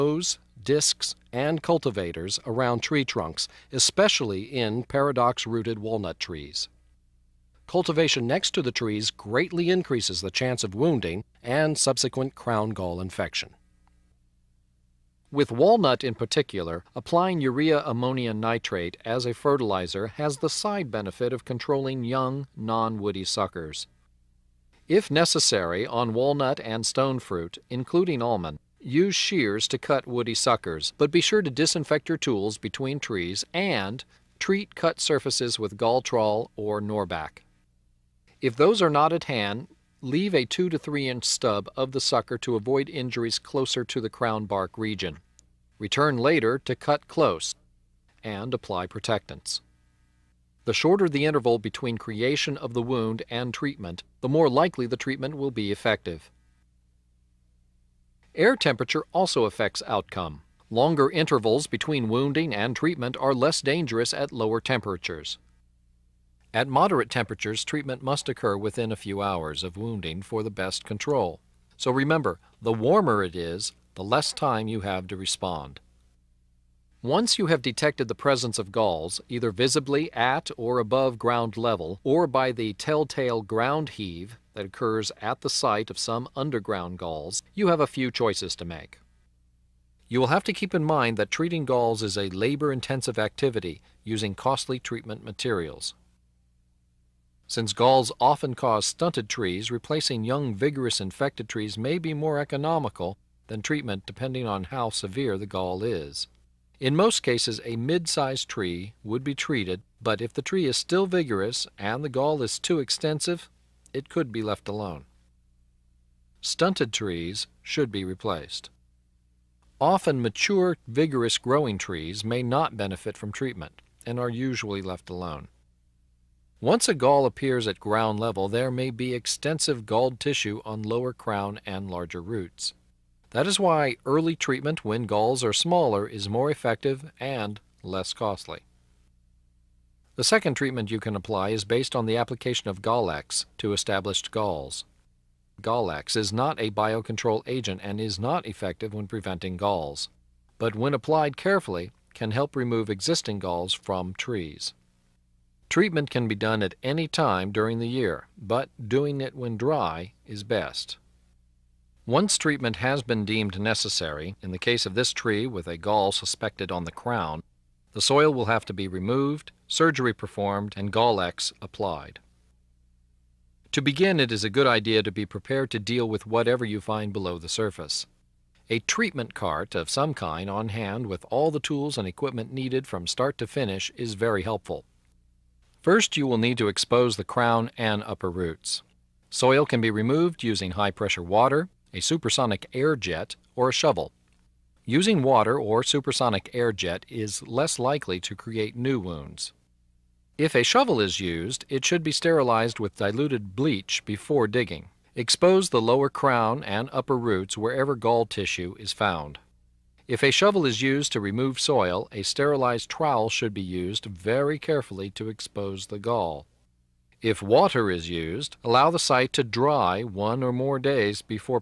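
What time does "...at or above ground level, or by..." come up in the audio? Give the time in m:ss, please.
1:20.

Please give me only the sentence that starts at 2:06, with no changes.
Once a gall appears at ground level, there may be extensive galled tissue on lower crown and larger roots.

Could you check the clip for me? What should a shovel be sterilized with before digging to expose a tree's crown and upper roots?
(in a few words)
diluted bleach.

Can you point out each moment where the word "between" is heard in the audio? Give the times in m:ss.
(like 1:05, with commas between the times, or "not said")
0:32, 0:51, 1:01.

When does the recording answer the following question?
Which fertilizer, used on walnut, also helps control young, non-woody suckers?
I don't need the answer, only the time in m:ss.
0:17.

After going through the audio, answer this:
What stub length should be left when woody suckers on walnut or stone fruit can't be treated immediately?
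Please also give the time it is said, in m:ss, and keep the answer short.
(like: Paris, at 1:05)
2 to 3 inch, at 0:40.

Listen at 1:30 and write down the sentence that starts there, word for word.
You will have to keep in mind that treating galls is a labor-intensive activity using costly treatment materials.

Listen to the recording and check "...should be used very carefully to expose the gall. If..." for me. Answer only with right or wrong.
right.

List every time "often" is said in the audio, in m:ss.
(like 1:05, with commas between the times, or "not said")
1:38, 1:59.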